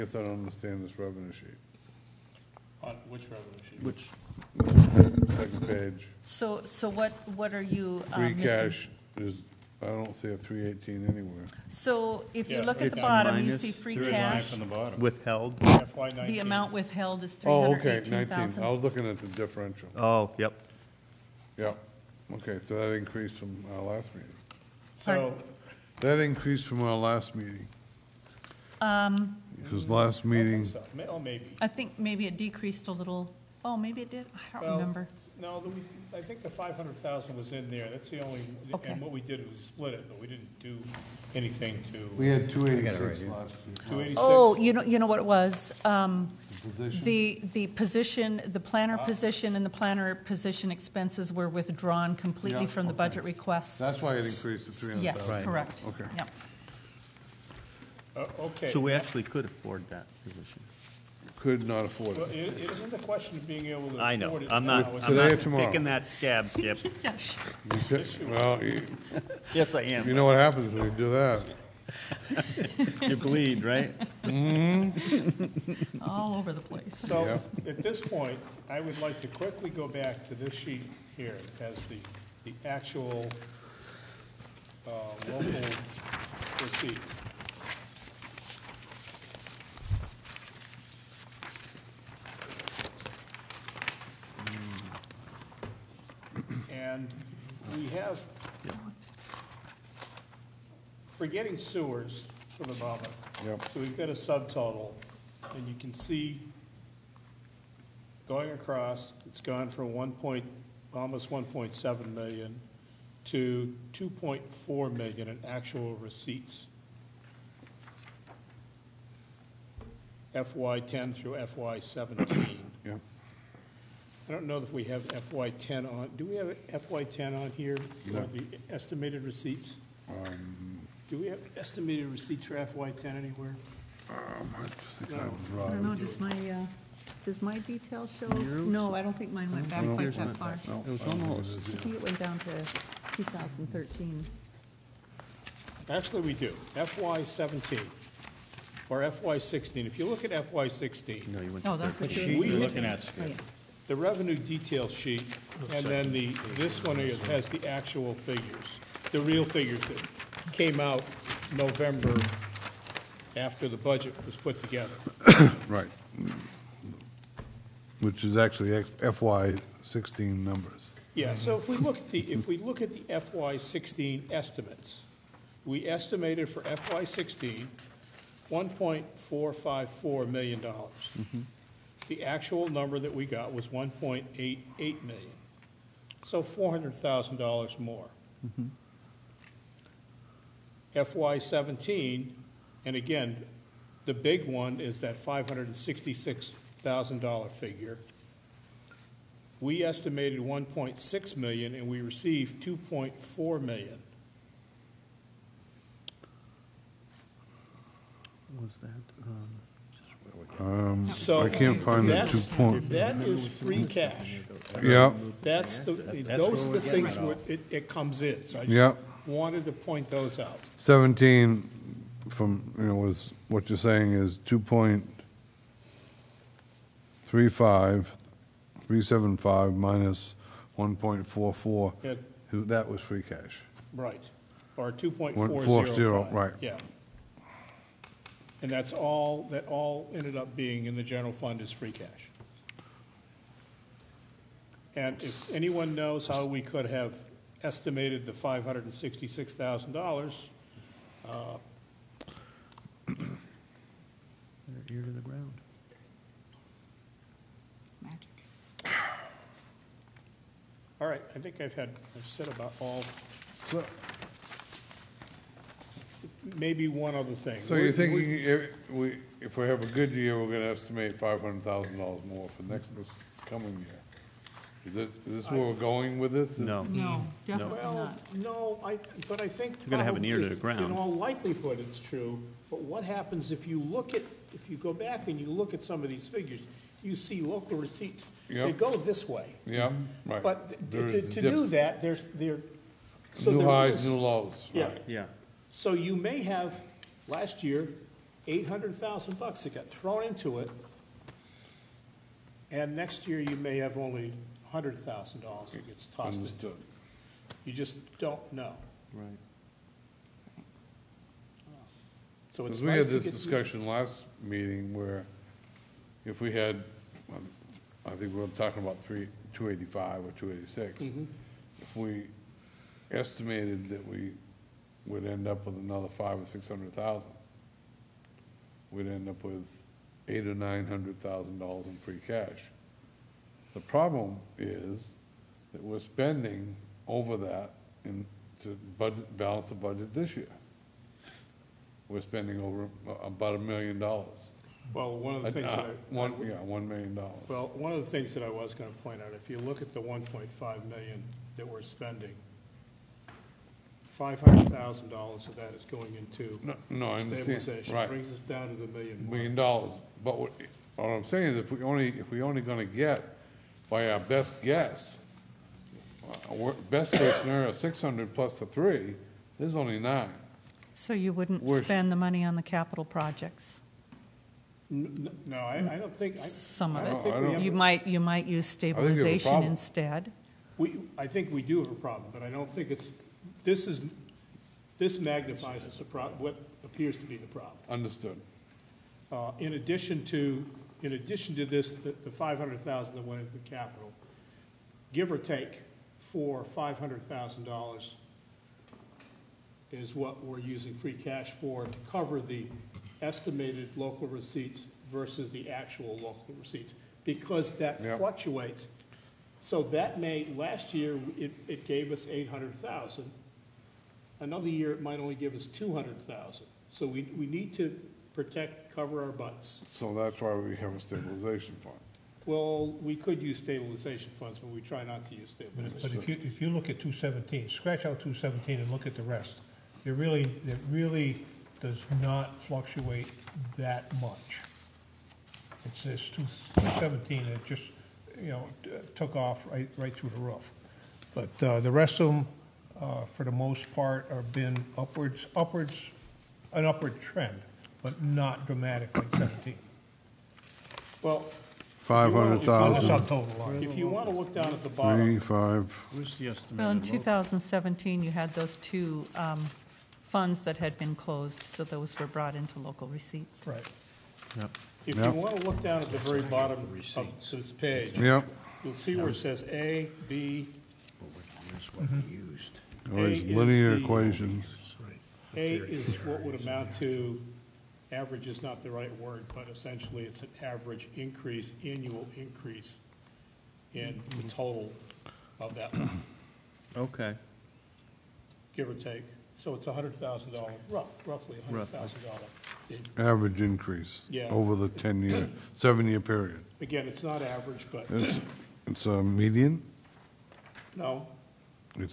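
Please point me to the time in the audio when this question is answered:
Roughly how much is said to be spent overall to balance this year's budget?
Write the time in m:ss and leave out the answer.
5:43.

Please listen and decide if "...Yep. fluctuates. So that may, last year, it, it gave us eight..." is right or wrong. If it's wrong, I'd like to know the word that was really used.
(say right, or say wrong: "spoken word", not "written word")
right.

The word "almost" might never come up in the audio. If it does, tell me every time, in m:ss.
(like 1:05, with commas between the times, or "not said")
1:50, 2:21.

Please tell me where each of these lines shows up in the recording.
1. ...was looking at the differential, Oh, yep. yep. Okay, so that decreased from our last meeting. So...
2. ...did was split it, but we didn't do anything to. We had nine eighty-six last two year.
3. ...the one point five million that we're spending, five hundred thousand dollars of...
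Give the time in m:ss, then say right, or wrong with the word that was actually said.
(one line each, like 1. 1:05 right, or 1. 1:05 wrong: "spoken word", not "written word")
1. 0:18 wrong: "increased", not "decreased"
2. 0:39 wrong: "two", not "nine"
3. 5:49 right.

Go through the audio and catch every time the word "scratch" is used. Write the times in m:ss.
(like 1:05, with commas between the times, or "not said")
7:07.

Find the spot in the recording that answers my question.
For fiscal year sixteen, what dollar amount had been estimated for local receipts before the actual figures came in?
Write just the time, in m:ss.
2:58.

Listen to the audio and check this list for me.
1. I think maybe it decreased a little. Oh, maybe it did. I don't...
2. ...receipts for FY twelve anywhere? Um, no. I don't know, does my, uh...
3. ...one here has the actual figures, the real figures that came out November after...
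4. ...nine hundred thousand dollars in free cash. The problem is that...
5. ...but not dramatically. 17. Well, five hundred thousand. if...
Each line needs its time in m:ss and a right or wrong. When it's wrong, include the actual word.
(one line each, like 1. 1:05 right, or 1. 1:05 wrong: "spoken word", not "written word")
1. 0:31 right
2. 2:12 wrong: "ten", not "twelve"
3. 2:36 right
4. 5:30 right
5. 7:28 right.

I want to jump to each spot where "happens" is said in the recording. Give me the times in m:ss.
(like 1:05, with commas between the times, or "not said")
1:10, 4:43.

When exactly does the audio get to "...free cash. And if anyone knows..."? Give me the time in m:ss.
4:01.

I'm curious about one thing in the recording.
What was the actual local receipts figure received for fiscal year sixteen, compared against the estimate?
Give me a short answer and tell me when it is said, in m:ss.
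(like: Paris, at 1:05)
1.88 million, at 3:03.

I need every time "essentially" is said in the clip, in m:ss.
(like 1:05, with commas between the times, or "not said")
7:59.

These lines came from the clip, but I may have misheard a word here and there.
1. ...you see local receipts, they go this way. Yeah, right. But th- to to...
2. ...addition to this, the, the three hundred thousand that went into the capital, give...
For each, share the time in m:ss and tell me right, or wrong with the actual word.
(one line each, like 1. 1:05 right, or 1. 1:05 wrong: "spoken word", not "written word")
1. 4:47 right
2. 6:31 wrong: "five", not "three".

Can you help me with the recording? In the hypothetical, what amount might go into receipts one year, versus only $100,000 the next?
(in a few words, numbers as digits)
$800,000.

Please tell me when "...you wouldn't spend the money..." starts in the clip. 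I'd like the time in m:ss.
6:11.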